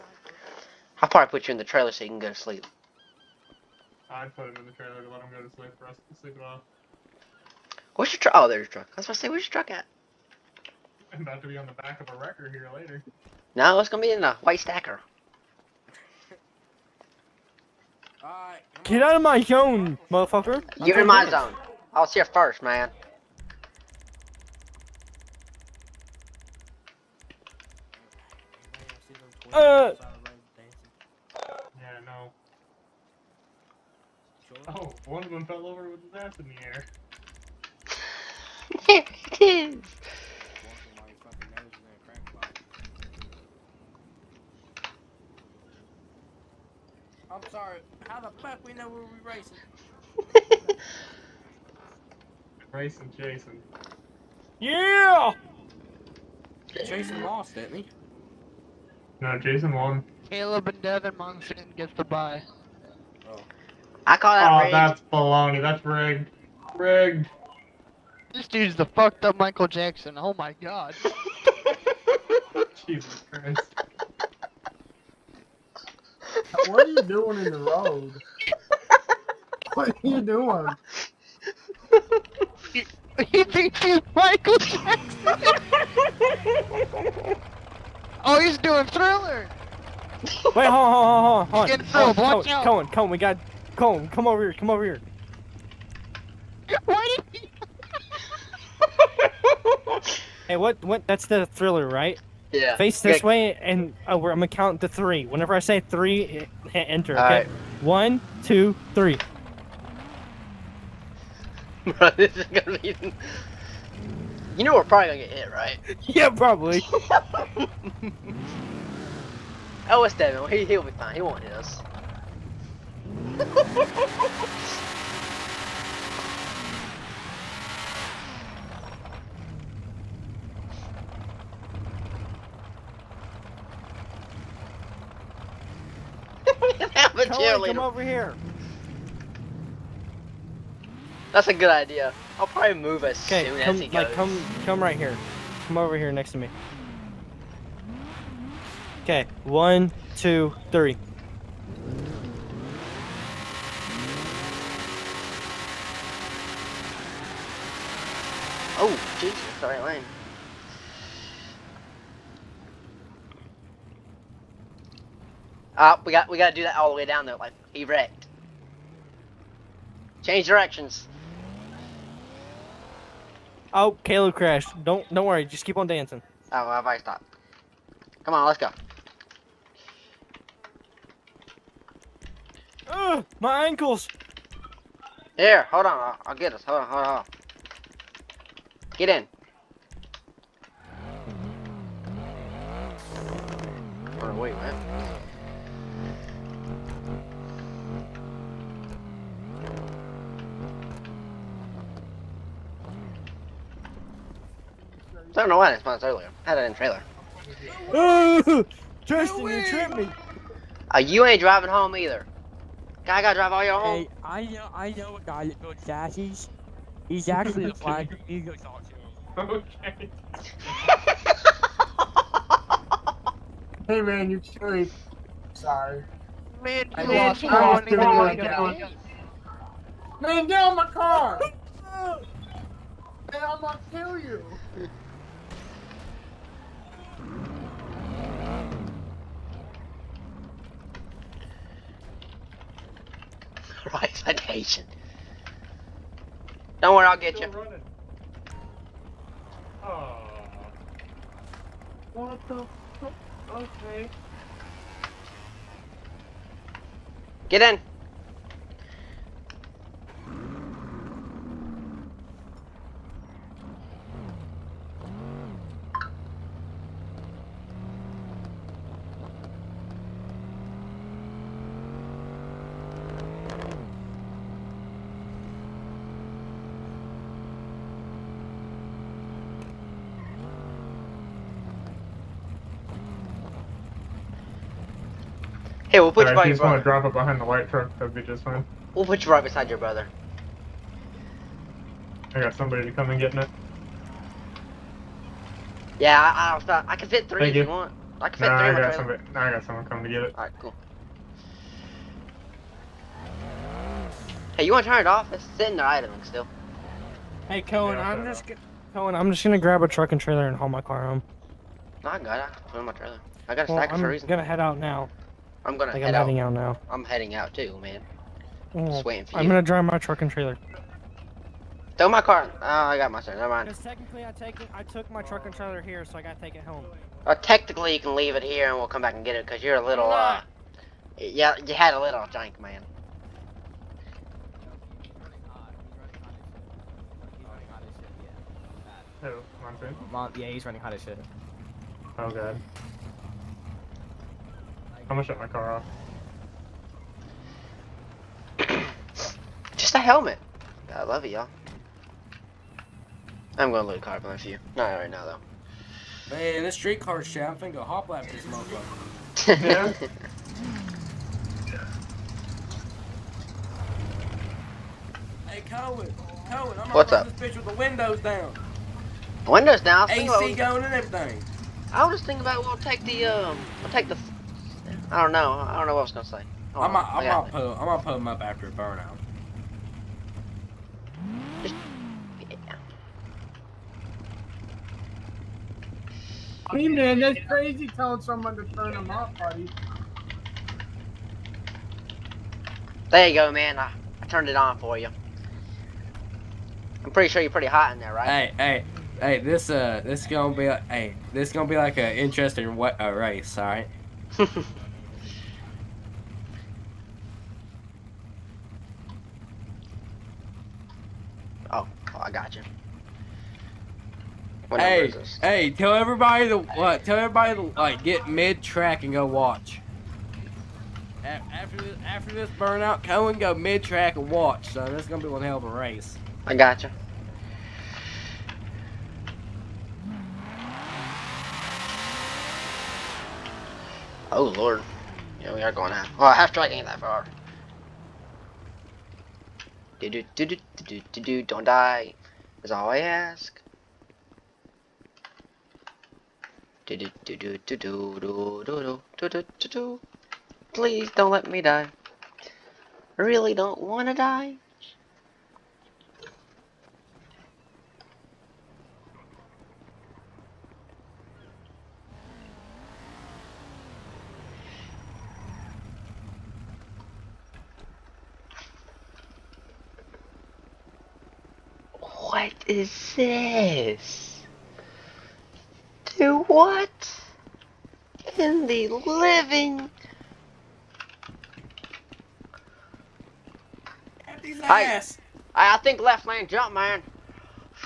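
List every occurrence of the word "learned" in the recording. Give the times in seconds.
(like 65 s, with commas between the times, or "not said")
not said.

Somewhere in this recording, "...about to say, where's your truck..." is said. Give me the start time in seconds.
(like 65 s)
9 s.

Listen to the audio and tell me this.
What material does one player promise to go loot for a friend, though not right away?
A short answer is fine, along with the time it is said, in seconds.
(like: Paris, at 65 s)
Carbon, at 354 s.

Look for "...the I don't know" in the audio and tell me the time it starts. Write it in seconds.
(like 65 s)
374 s.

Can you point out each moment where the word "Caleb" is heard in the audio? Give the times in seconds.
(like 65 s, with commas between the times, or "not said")
60 s, 174 s.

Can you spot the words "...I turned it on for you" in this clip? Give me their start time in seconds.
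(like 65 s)
394 s.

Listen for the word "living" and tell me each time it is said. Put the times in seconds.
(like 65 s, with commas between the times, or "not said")
478 s.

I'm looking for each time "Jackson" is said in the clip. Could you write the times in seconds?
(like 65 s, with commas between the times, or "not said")
69 s, 84 s.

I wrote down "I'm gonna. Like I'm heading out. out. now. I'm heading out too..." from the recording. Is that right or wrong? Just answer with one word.
right.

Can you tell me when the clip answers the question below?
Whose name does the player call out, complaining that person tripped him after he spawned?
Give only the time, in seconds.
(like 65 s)
209 s.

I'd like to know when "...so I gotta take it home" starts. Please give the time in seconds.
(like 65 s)
326 s.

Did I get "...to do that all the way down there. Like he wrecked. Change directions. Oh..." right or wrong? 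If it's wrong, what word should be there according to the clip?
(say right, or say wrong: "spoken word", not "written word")
right.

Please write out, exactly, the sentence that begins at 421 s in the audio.
after this, after this burnout, Cohen go mid track and watch.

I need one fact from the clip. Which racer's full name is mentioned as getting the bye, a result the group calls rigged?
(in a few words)
Devin Monson.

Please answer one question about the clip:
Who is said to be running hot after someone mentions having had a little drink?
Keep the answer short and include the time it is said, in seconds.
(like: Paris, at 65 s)
Monty, at 339 s.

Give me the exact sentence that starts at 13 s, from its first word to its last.
No, it's gonna be in a white stacker.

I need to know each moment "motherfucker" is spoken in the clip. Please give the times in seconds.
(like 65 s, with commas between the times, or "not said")
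20 s, 358 s.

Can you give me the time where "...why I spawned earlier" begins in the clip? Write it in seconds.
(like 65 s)
205 s.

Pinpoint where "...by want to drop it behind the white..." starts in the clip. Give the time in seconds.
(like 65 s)
286 s.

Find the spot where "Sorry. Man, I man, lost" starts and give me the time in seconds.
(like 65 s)
225 s.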